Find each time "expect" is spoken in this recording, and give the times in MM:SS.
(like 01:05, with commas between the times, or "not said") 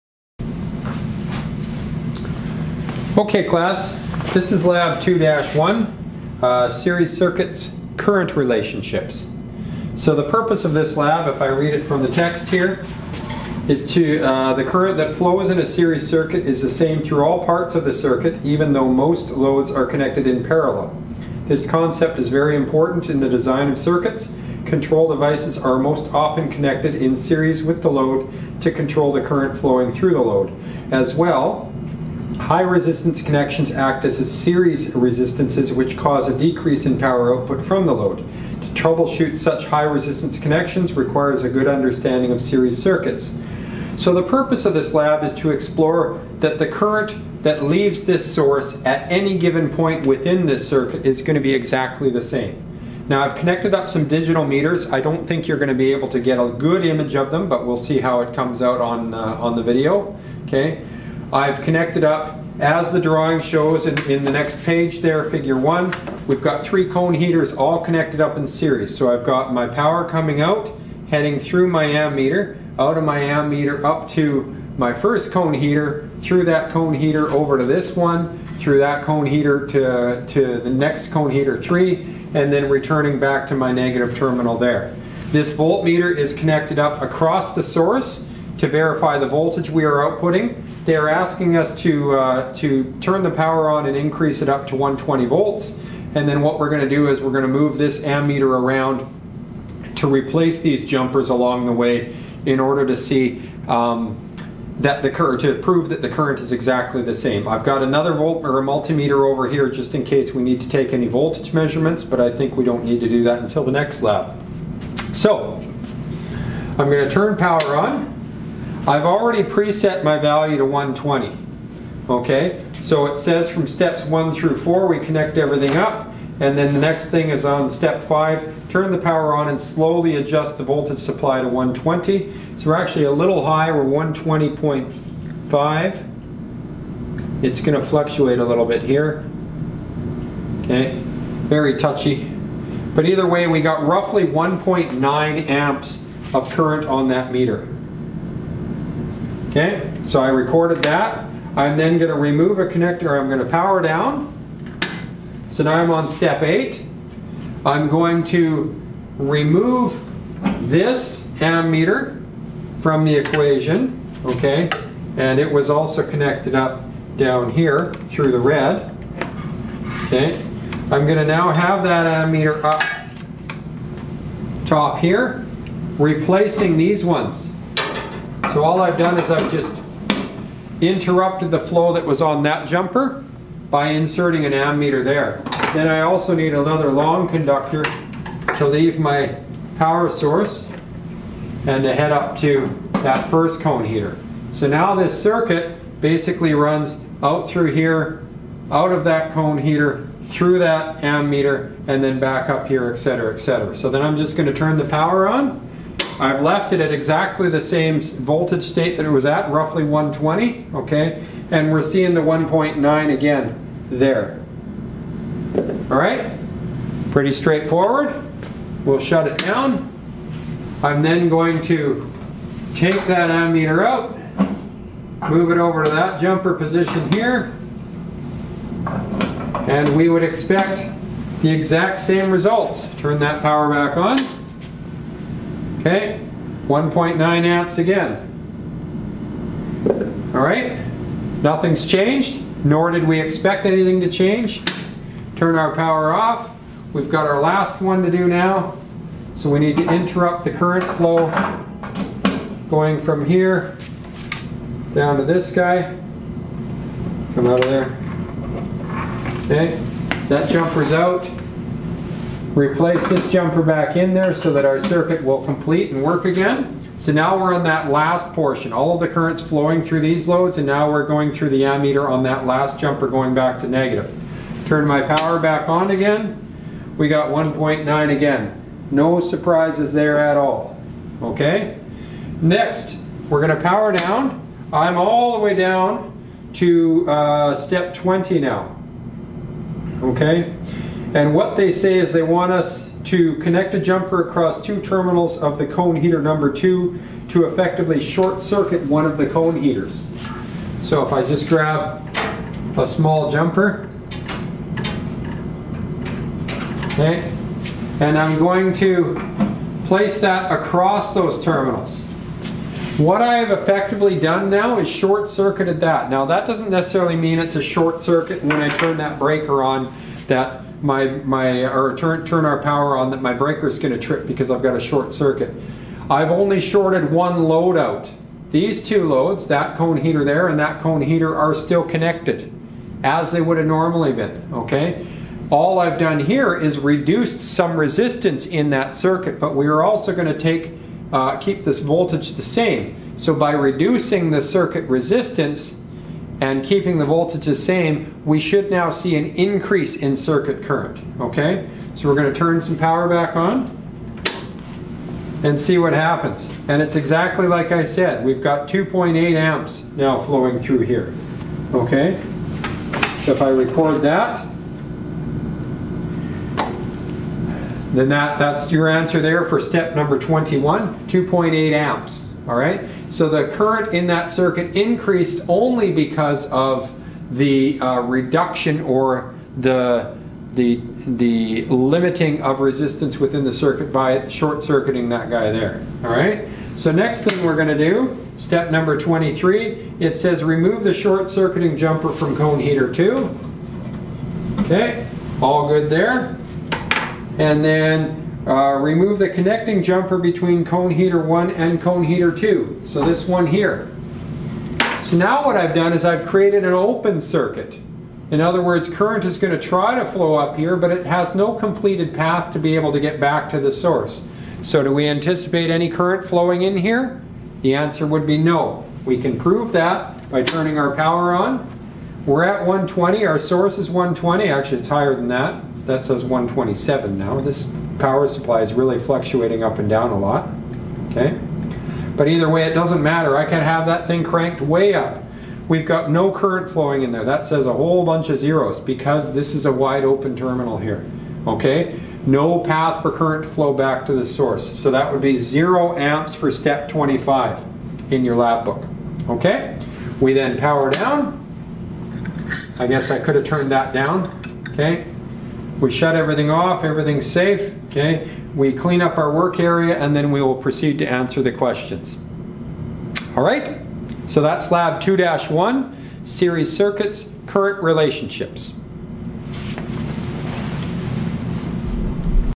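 03:50, 04:03.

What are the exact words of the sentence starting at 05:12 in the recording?
What I have effectively done now is short circuited that.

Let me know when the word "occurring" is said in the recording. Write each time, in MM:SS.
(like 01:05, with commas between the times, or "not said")
not said.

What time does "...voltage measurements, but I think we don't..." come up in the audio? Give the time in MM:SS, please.
01:51.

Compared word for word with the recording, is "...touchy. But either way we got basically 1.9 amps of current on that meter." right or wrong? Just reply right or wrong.
wrong.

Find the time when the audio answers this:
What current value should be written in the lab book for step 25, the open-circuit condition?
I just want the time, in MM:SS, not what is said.
07:25.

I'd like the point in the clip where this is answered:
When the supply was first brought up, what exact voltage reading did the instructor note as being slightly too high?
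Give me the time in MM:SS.
02:13.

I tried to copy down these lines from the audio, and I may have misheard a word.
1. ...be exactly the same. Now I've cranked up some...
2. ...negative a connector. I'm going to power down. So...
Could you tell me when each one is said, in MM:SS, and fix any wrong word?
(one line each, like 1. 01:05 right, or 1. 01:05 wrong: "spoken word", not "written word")
1. 00:51 wrong: "connected", not "cranked"
2. 02:32 wrong: "remove", not "negative".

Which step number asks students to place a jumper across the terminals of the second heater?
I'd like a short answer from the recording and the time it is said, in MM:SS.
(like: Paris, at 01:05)
20, at 04:47.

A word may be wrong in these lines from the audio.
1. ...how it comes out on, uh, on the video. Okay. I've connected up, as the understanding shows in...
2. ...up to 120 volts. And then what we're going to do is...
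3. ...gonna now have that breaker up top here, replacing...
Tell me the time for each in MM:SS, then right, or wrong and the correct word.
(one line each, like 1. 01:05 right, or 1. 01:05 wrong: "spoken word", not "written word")
1. 00:58 wrong: "drawing", not "understanding"
2. 01:34 right
3. 02:51 wrong: "ammeter", not "breaker".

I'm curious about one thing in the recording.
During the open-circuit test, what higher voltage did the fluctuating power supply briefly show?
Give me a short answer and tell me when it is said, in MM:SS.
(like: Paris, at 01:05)
127, at 07:06.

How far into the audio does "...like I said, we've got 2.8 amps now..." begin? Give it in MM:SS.
05:57.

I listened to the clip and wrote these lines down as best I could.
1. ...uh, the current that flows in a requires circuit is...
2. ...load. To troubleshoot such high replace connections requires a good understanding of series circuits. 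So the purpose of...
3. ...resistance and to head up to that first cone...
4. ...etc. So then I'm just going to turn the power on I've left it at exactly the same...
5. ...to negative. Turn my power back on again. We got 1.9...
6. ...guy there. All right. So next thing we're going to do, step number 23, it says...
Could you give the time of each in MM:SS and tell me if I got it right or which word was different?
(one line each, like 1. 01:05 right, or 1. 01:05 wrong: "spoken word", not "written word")
1. 00:14 wrong: "series", not "requires"
2. 00:37 wrong: "resistance", not "replace"
3. 03:10 wrong: "source", not "resistance"
4. 03:23 right
5. 04:33 right
6. 06:25 right.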